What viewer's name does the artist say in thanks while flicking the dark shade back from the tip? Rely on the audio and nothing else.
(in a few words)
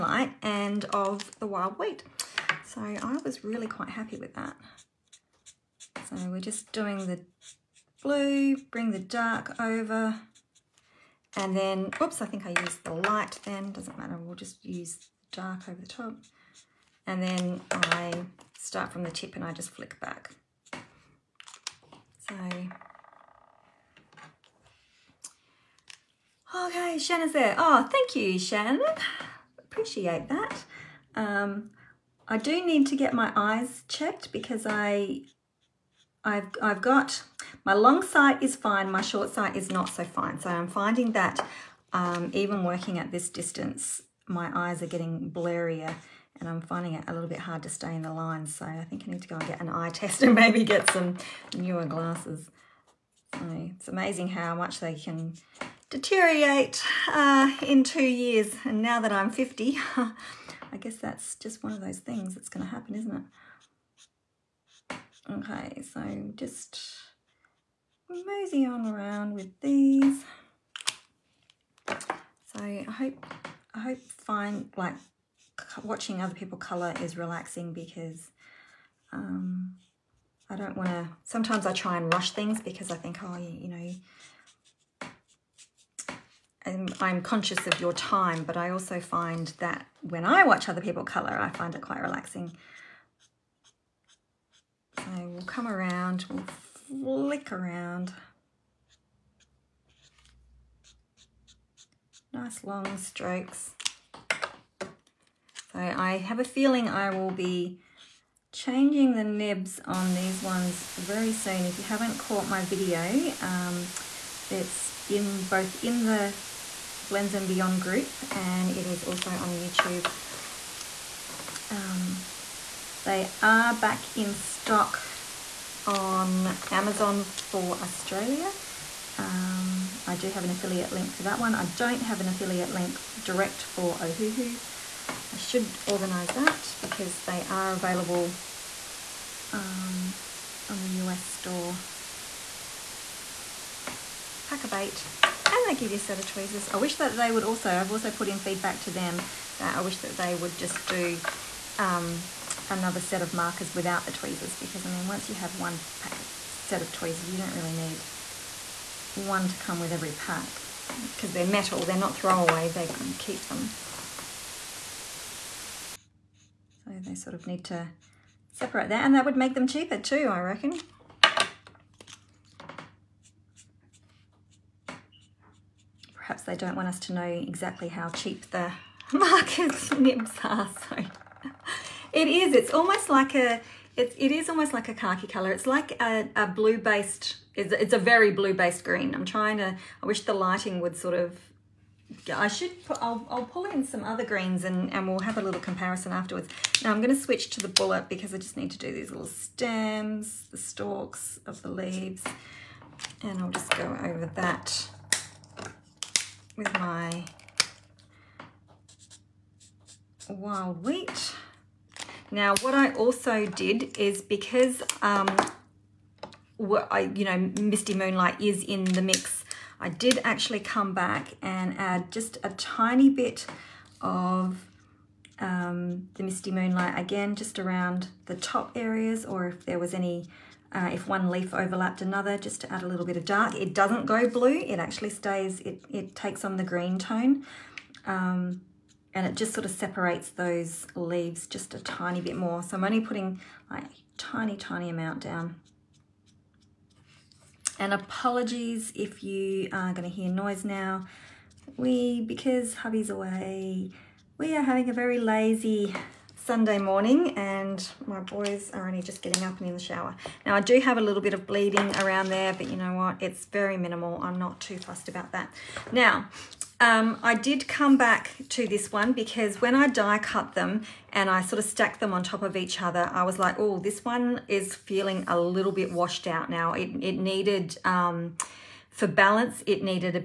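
Shan.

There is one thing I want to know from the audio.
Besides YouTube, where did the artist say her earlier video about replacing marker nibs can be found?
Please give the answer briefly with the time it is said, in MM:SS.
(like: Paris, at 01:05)
Blends and Beyond group, at 01:57.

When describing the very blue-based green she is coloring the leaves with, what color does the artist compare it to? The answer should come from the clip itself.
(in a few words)
Khaki.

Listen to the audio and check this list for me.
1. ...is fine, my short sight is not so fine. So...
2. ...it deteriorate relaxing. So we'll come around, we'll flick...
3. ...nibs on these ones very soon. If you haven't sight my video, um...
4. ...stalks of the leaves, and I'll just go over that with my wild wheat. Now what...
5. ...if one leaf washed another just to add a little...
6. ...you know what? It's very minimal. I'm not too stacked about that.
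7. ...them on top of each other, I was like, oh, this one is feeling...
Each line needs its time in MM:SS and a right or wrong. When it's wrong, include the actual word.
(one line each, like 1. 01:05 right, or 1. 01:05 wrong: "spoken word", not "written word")
1. 00:38 right
2. 01:31 wrong: "quite", not "deteriorate"
3. 01:49 wrong: "caught", not "sight"
4. 03:20 right
5. 03:50 wrong: "overlapped", not "washed"
6. 04:22 wrong: "fussed", not "stacked"
7. 04:32 right.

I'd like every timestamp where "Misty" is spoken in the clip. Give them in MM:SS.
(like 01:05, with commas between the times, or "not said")
03:37, 03:46.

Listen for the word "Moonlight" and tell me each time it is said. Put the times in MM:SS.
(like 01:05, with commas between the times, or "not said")
03:37, 03:46.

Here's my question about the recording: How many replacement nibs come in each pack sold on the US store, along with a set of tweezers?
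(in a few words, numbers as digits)
8.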